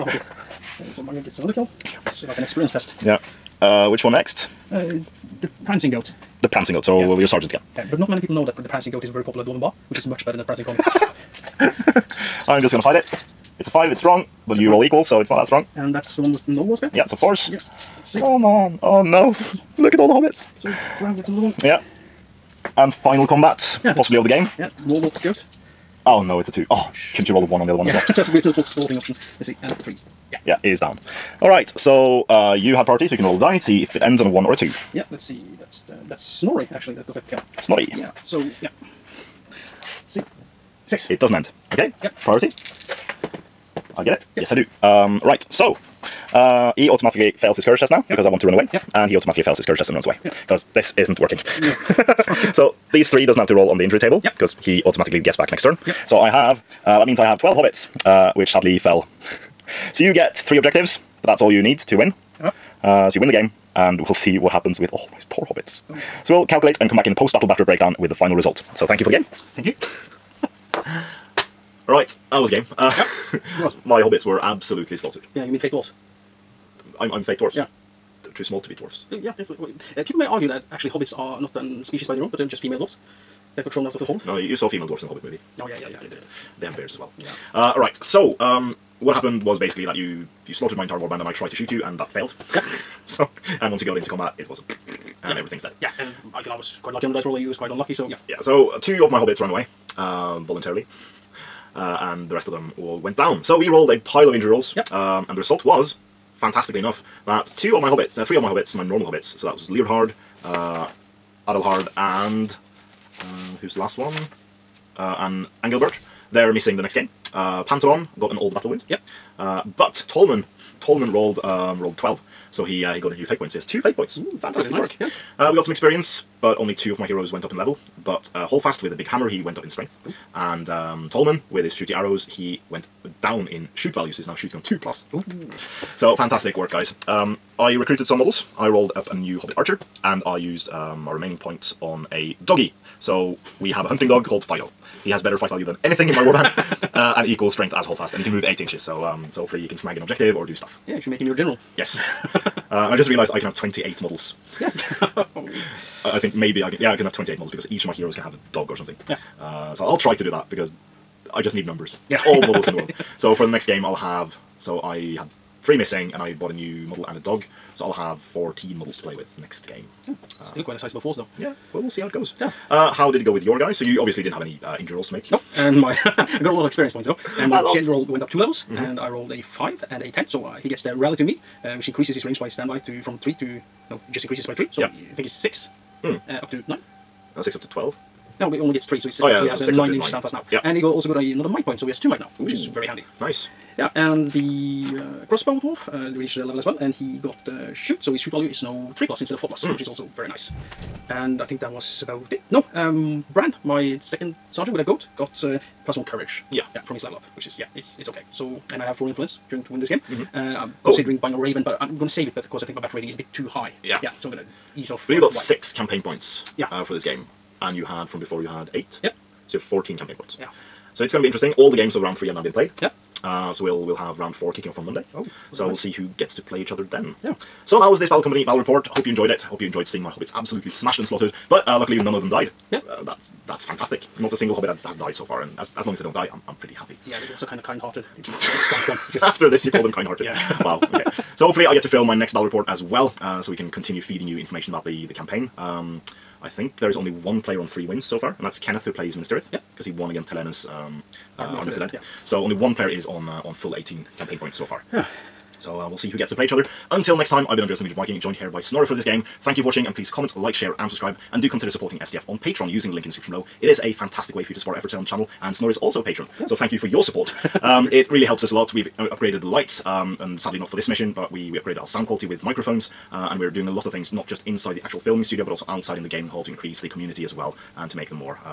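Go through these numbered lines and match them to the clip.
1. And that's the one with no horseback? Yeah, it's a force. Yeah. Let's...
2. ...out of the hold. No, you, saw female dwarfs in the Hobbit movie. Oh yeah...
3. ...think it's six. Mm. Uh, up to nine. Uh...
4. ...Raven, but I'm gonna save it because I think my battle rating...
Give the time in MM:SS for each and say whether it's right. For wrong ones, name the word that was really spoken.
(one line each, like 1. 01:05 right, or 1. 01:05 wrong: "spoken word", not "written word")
1. 00:15 right
2. 01:23 right
3. 03:05 right
4. 03:31 right.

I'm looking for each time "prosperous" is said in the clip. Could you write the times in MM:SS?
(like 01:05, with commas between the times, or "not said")
not said.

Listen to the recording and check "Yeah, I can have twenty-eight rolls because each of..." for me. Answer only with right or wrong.
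wrong.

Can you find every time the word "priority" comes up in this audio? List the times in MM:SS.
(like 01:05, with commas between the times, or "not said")
00:32, 00:42.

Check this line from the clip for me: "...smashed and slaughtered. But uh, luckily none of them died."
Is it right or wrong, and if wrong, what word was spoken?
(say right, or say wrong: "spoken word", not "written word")
right.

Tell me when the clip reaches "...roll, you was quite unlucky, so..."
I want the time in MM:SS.
01:37.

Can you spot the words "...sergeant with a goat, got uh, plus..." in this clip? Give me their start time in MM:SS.
03:24.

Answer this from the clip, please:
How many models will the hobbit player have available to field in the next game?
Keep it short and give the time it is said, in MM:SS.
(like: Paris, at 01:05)
14, at 02:48.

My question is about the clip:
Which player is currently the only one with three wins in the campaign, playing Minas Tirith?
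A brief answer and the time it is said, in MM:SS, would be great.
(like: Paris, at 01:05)
Kenneth, at 04:08.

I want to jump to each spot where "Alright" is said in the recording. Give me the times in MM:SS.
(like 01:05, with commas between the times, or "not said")
00:31.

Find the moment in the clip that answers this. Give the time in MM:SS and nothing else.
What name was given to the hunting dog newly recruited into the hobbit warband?
02:24.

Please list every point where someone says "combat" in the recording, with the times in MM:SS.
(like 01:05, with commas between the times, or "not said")
00:23, 01:34.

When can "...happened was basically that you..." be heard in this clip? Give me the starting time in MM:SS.
01:29.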